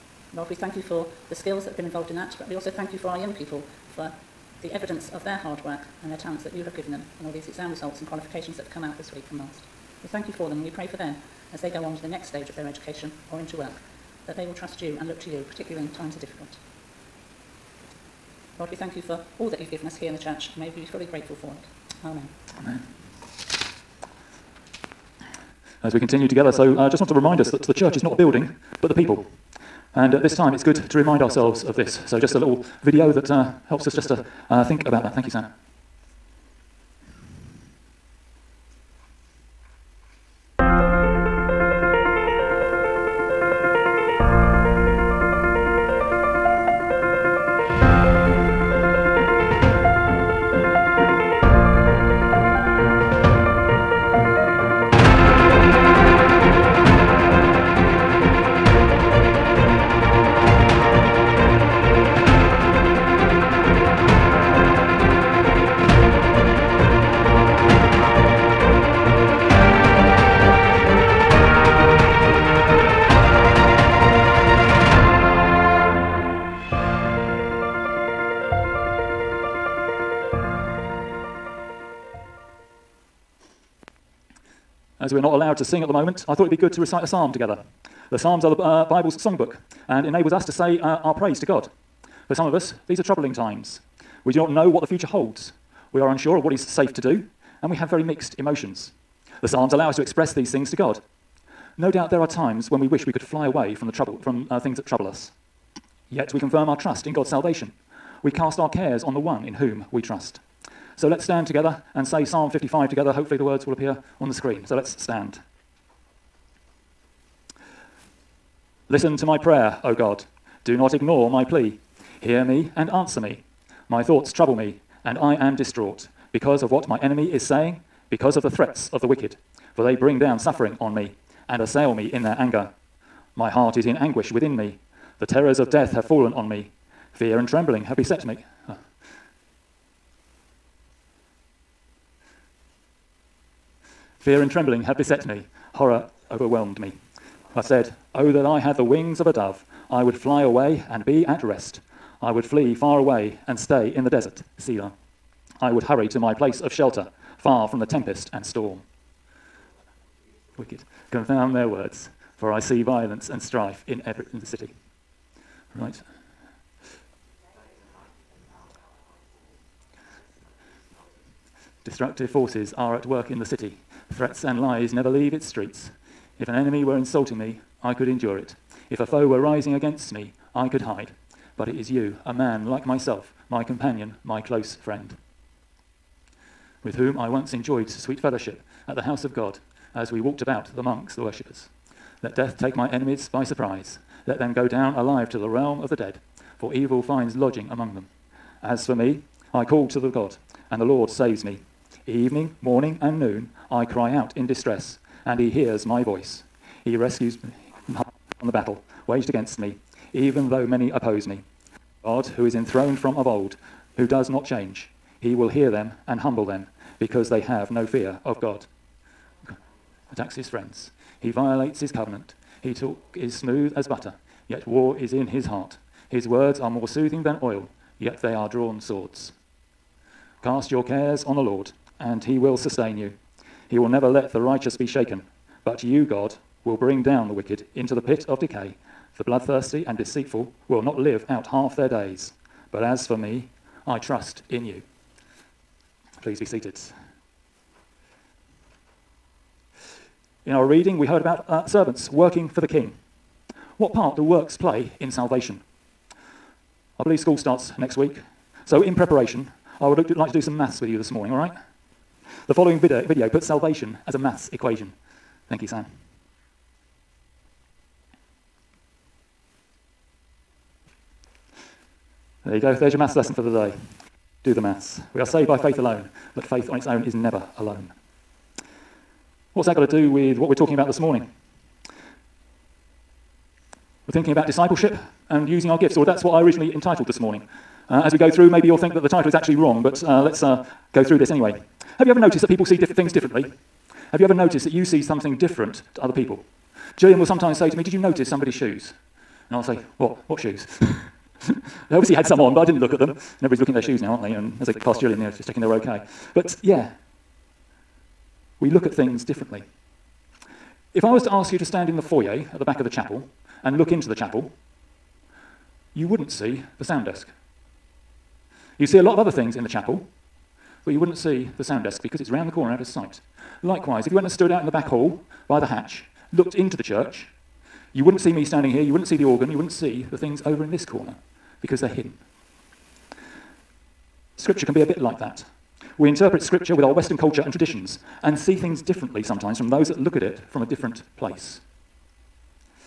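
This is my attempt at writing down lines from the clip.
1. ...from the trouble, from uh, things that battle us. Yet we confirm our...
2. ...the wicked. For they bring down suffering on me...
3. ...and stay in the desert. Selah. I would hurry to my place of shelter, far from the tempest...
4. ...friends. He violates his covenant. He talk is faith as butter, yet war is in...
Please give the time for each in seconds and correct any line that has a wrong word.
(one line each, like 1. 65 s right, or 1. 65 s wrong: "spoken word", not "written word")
1. 103 s wrong: "trouble", not "battle"
2. 129 s right
3. 153 s right
4. 220 s wrong: "smooth", not "faith".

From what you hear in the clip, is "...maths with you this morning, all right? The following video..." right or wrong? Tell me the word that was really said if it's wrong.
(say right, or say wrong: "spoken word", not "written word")
right.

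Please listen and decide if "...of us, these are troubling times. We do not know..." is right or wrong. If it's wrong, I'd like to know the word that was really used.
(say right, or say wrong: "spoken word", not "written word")
right.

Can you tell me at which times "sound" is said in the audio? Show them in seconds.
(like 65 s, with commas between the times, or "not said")
316 s, 321 s.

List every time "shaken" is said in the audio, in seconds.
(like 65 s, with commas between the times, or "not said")
234 s.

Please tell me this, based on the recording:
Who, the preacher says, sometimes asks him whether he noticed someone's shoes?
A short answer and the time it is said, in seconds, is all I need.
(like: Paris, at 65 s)
Gillian, at 296 s.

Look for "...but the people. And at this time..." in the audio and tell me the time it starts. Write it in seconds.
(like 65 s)
28 s.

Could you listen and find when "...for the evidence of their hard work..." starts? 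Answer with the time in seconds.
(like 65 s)
3 s.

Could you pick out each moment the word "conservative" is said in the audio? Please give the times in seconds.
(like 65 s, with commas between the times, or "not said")
not said.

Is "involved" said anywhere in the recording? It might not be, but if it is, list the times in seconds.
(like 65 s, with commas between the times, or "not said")
1 s.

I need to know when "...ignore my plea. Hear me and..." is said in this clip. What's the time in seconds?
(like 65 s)
120 s.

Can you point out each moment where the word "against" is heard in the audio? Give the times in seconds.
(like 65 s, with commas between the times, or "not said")
179 s, 209 s.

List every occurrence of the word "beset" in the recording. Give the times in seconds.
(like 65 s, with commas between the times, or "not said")
137 s, 144 s.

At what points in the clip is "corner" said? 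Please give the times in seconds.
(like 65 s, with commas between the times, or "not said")
322 s, 330 s.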